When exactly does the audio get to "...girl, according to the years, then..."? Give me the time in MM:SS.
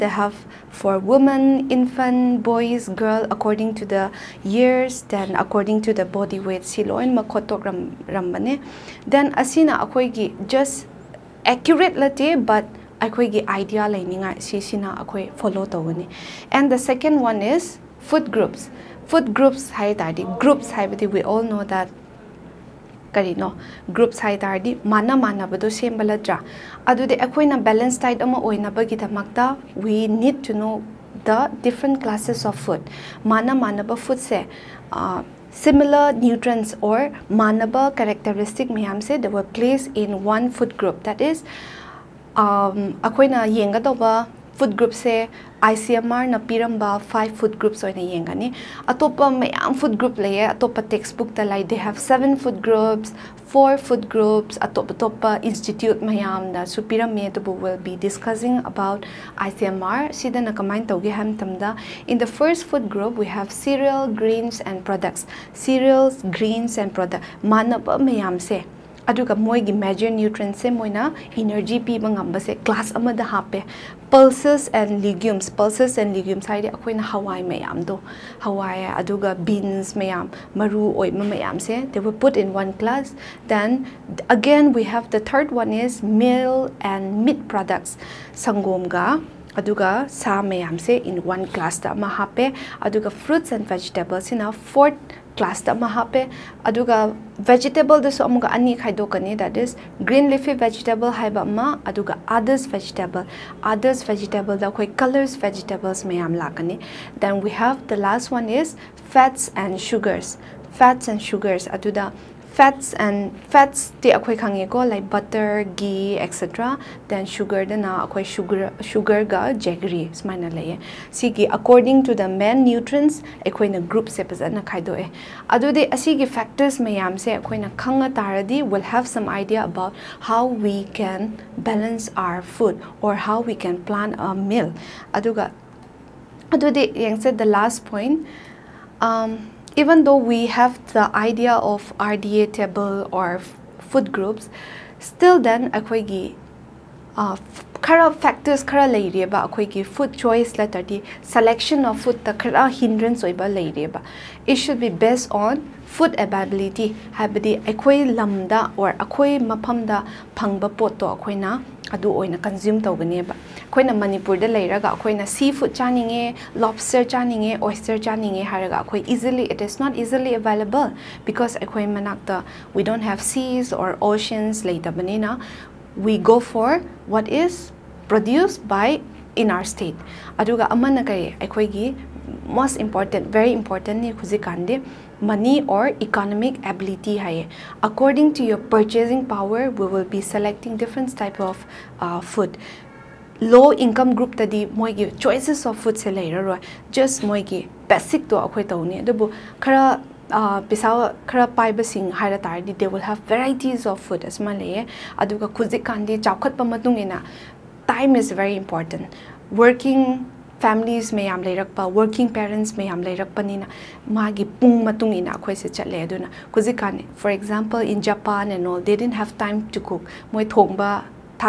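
00:02.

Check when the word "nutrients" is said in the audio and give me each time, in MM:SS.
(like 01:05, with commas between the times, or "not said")
00:36, 02:02.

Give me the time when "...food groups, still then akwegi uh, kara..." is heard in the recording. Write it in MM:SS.
02:23.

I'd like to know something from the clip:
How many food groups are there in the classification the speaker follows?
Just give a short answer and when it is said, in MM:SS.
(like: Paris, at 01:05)
5, at 00:47.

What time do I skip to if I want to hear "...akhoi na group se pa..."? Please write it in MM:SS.
02:03.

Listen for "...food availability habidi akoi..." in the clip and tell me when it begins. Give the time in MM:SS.
02:35.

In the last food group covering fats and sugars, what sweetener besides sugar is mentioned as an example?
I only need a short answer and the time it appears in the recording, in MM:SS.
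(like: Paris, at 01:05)
jaggery, at 01:59.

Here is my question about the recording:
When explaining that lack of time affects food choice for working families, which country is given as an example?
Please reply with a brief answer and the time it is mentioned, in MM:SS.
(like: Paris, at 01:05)
Japan, at 03:38.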